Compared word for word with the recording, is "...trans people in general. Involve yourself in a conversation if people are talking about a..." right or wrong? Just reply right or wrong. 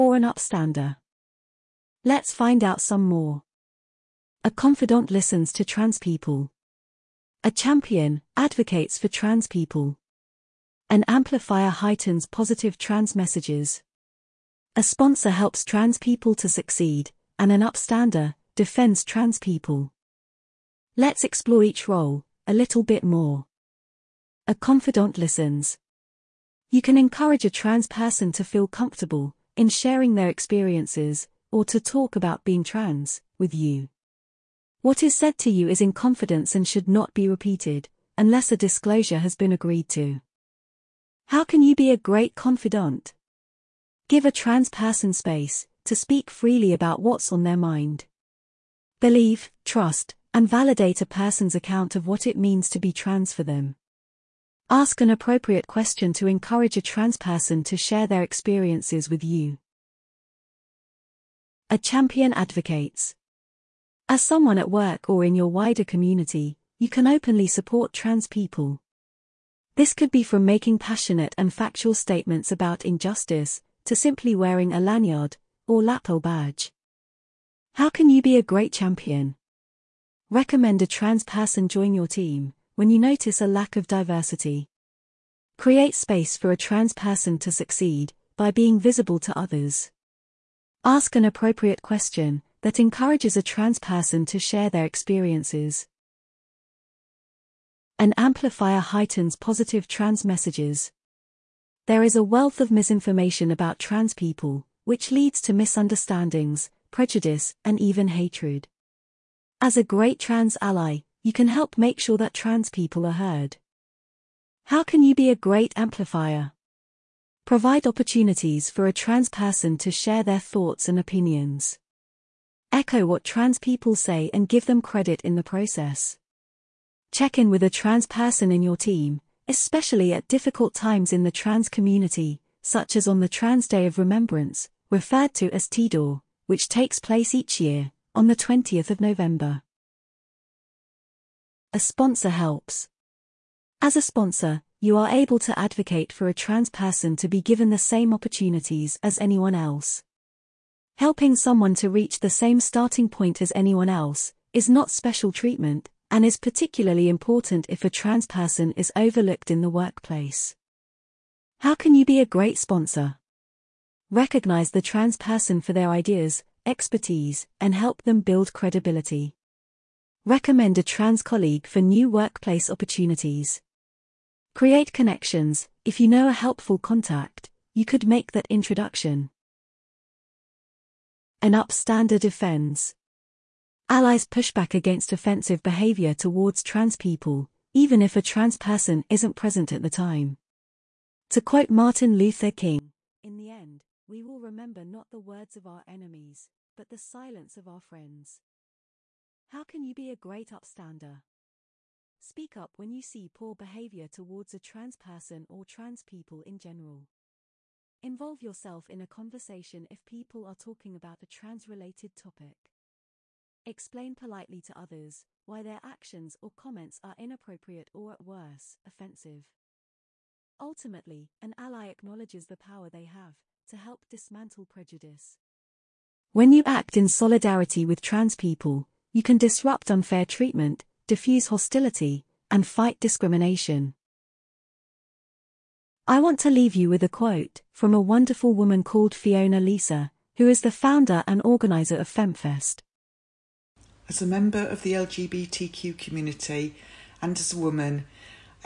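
right.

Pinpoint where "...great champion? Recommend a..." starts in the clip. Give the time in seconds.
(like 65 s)
78 s.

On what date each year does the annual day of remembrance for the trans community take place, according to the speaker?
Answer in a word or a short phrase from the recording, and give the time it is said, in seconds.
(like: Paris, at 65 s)
20th of November, at 138 s.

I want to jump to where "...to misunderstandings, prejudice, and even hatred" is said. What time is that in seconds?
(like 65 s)
105 s.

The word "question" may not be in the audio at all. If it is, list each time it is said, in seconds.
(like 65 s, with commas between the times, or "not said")
55 s, 91 s.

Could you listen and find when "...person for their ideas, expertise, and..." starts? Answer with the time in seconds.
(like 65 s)
165 s.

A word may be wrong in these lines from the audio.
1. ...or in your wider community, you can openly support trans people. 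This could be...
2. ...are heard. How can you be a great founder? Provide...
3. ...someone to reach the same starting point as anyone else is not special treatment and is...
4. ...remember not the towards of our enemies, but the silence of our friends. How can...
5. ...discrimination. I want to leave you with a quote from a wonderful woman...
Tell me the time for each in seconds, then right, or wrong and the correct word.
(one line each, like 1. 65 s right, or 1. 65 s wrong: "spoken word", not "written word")
1. 65 s right
2. 113 s wrong: "amplifier", not "founder"
3. 151 s right
4. 194 s wrong: "words", not "towards"
5. 232 s right.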